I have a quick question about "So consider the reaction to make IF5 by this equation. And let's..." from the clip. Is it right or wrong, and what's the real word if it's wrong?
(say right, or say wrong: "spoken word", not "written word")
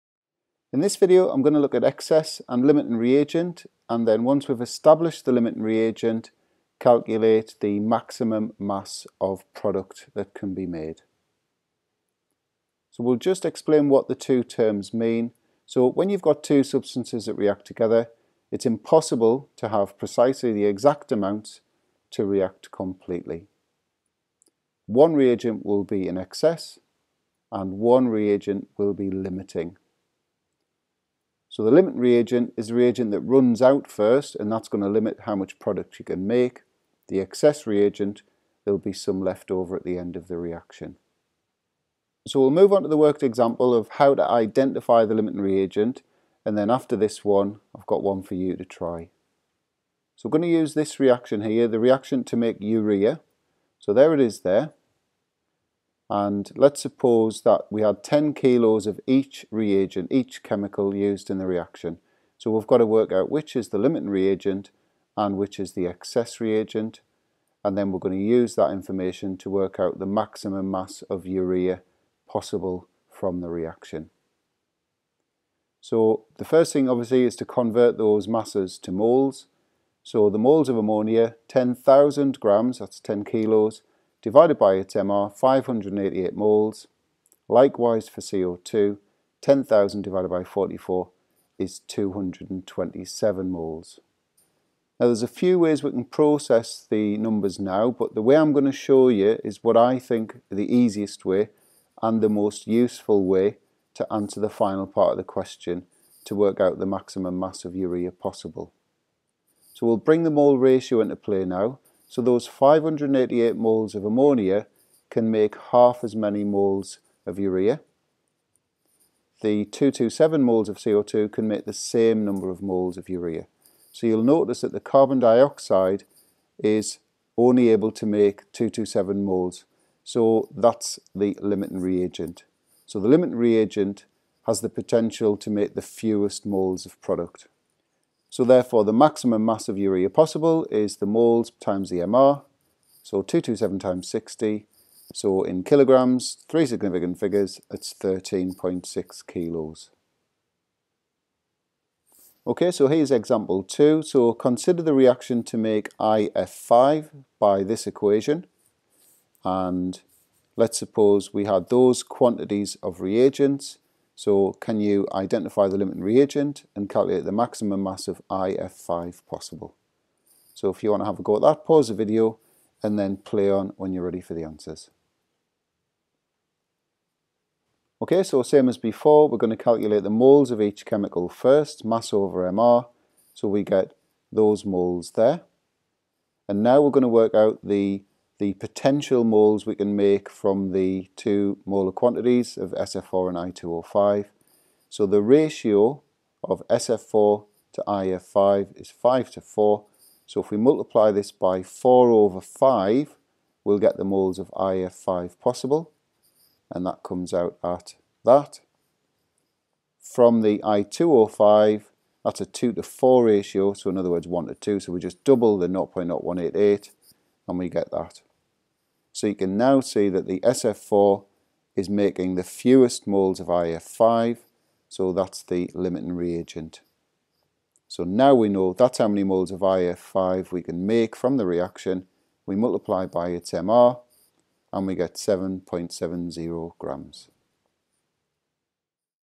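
right.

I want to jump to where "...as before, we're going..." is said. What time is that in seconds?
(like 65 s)
178 s.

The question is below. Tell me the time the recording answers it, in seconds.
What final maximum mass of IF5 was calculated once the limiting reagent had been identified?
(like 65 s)
235 s.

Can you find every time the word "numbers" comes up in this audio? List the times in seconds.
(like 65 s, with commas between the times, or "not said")
97 s, 122 s.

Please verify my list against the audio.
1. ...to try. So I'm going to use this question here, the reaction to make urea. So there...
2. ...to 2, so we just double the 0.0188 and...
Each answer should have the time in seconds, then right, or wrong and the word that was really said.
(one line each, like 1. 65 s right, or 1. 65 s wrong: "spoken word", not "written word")
1. 48 s wrong: "reaction", not "question"
2. 214 s right.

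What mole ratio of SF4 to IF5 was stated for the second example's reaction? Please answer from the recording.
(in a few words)
5 to 4.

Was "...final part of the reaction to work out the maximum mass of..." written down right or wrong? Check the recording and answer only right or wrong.
wrong.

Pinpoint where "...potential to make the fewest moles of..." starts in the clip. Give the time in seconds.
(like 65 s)
134 s.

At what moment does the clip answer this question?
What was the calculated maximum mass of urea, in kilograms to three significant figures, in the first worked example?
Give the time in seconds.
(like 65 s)
147 s.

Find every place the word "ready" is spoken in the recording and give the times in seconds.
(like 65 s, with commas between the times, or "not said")
174 s.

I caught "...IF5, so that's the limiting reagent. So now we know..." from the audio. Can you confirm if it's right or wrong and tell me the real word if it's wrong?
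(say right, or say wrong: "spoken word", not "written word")
right.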